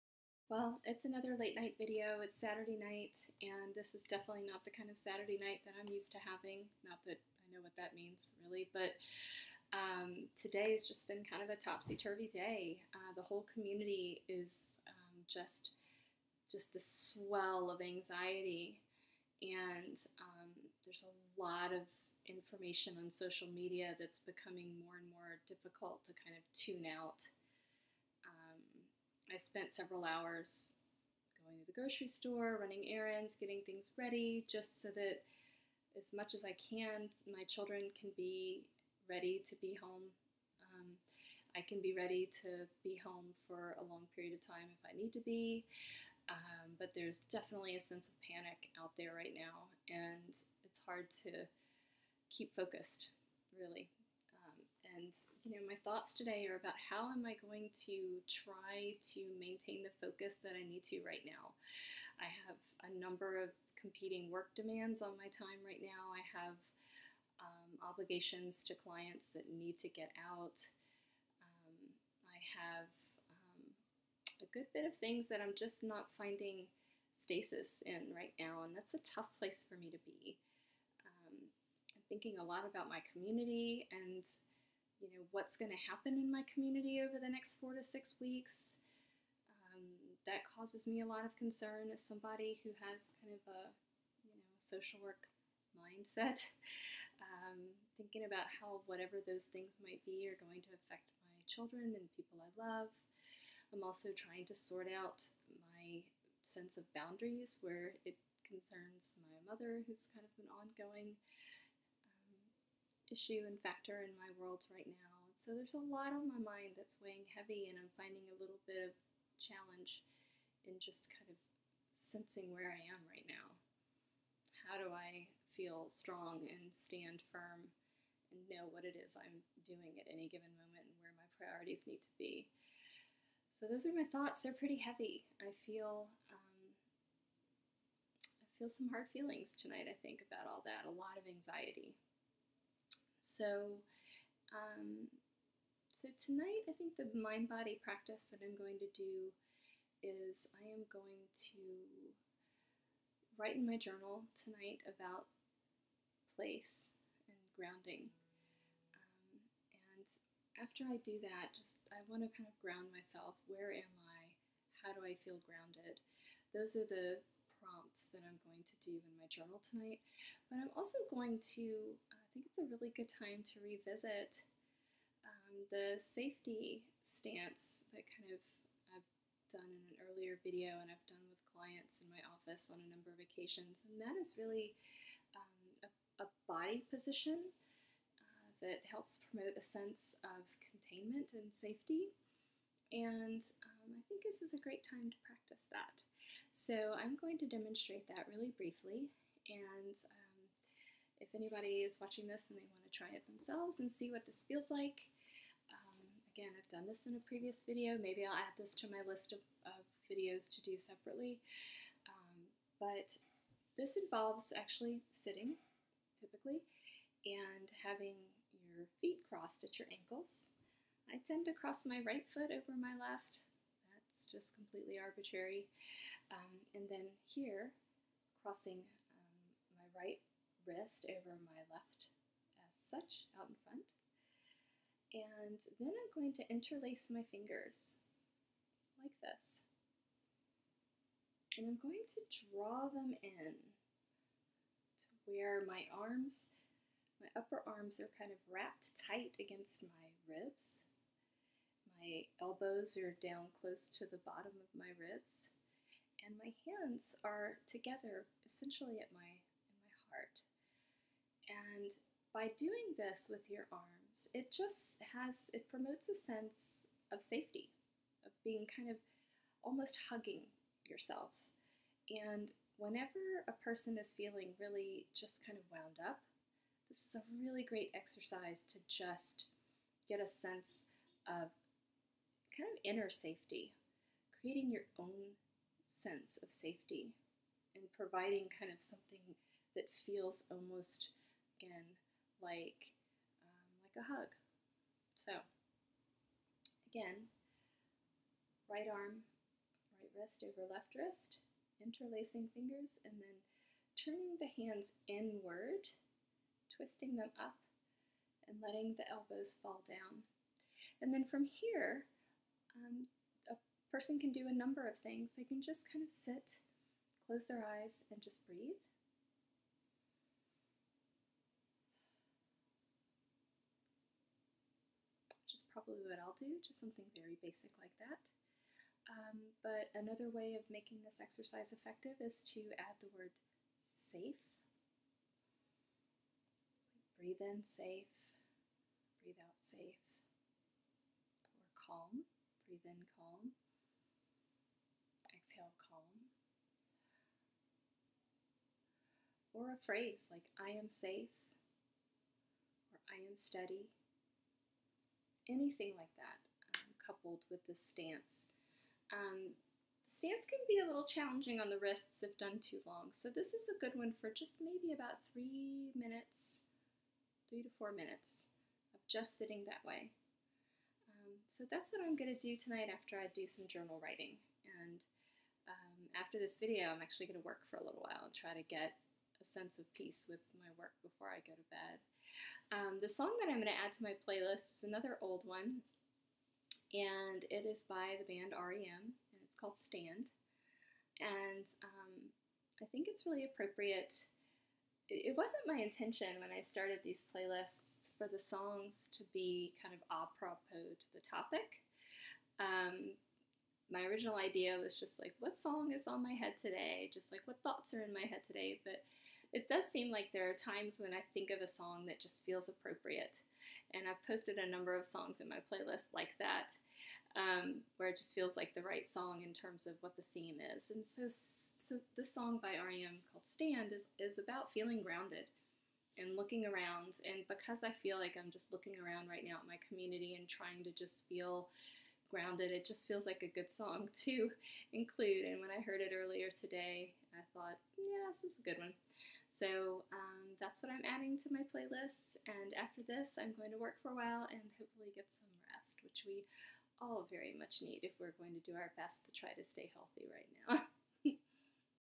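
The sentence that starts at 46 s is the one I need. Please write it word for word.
Um, but there's definitely a sense of panic out there right now, and it's hard to keep focused, really.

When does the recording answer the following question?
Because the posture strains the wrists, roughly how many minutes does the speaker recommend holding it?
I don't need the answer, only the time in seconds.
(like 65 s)
367 s.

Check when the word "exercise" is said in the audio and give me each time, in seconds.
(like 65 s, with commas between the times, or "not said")
277 s, 331 s.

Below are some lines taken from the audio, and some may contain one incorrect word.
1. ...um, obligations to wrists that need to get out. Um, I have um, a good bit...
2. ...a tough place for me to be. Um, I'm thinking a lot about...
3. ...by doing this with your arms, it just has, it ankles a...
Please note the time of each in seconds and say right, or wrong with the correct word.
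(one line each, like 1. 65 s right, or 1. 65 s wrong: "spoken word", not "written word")
1. 67 s wrong: "clients", not "wrists"
2. 78 s right
3. 262 s wrong: "promotes", not "ankles".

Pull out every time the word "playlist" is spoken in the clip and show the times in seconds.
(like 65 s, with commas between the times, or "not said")
384 s, 397 s, 415 s, 441 s.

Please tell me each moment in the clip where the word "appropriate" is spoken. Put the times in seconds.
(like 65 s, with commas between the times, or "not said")
393 s, 412 s.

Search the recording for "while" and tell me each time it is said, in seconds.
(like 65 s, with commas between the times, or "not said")
378 s, 444 s.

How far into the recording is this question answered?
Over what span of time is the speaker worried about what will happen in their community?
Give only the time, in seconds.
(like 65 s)
87 s.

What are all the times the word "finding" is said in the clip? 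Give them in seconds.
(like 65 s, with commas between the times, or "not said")
76 s, 117 s.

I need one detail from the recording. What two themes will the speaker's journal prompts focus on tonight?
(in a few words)
Place and grounding.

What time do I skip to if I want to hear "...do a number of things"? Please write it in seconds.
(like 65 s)
314 s.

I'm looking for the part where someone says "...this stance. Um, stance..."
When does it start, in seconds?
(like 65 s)
357 s.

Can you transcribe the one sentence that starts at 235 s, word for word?
And then I'm going to interlace my fingers like this.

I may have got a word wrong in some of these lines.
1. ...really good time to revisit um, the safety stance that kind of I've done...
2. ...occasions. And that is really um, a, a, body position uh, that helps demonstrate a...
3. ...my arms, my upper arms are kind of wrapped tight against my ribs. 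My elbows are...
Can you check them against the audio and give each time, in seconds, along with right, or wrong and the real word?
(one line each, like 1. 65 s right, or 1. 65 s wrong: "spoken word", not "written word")
1. 172 s right
2. 183 s wrong: "promote", not "demonstrate"
3. 245 s right.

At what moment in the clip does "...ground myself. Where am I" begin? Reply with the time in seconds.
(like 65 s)
162 s.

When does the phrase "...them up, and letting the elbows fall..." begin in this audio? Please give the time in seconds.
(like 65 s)
307 s.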